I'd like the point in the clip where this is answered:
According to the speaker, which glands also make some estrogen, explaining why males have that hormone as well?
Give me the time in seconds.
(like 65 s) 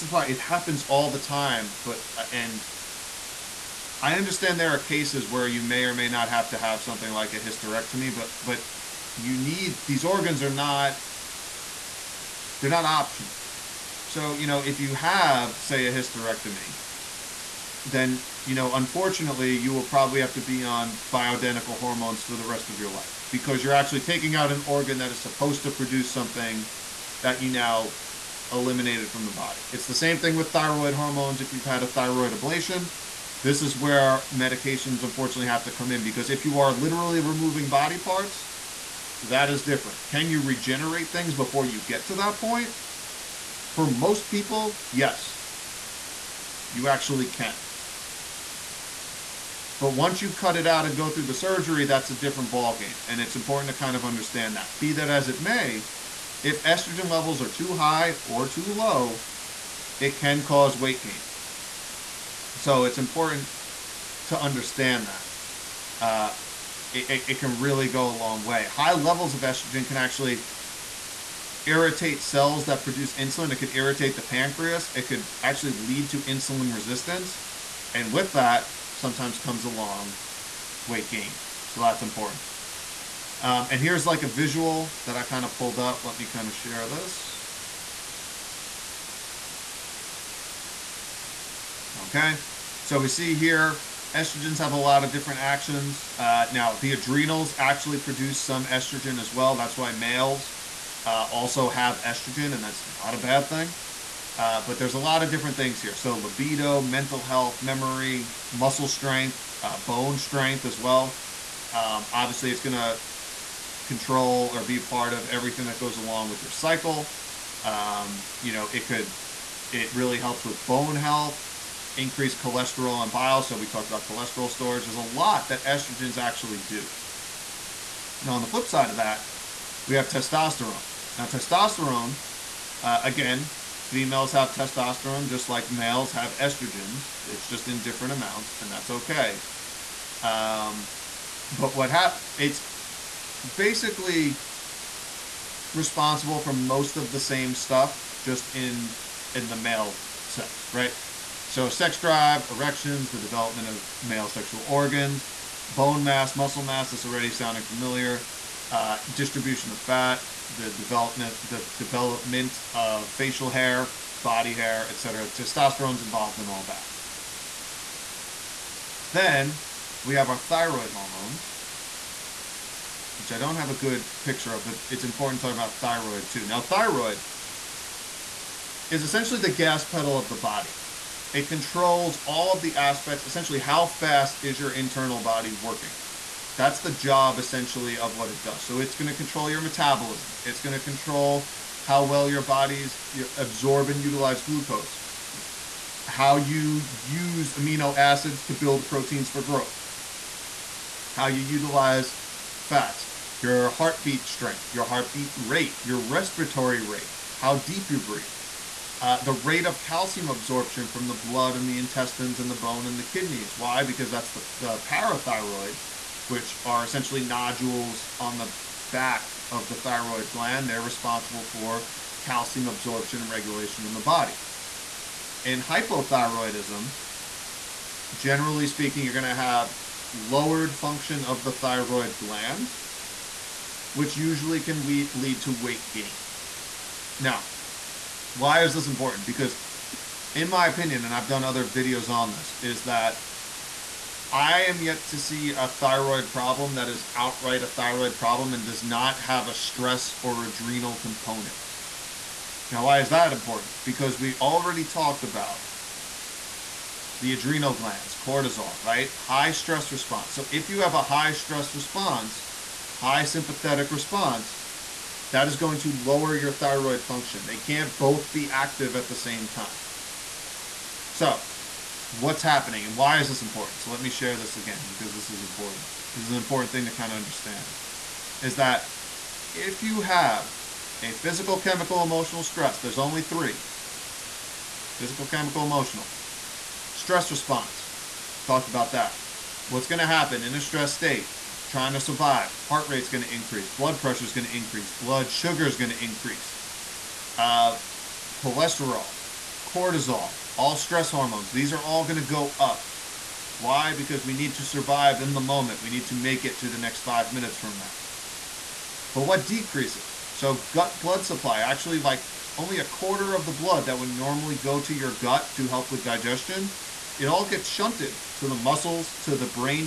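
96 s.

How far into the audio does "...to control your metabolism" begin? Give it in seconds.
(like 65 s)
189 s.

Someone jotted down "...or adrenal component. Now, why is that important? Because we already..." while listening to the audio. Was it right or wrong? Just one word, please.
right.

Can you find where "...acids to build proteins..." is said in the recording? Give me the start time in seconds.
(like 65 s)
197 s.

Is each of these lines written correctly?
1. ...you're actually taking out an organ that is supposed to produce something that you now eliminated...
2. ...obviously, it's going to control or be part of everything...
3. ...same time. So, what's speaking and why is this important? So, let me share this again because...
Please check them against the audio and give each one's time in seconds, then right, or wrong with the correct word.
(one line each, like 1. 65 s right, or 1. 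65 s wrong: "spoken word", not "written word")
1. 23 s right
2. 112 s right
3. 269 s wrong: "happening", not "speaking".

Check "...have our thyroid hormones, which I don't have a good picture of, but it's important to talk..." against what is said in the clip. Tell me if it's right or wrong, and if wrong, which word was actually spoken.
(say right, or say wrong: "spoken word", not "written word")
right.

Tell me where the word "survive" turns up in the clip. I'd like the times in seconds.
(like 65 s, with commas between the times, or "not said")
291 s, 304 s.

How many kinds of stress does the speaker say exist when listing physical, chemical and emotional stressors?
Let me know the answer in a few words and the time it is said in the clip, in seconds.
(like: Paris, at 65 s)
3, at 283 s.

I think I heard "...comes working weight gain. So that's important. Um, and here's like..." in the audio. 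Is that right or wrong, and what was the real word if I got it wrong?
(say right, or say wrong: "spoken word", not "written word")
wrong: "along", not "working".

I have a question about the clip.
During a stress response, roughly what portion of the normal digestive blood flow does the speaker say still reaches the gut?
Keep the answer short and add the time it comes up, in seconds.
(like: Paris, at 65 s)
a quarter, at 312 s.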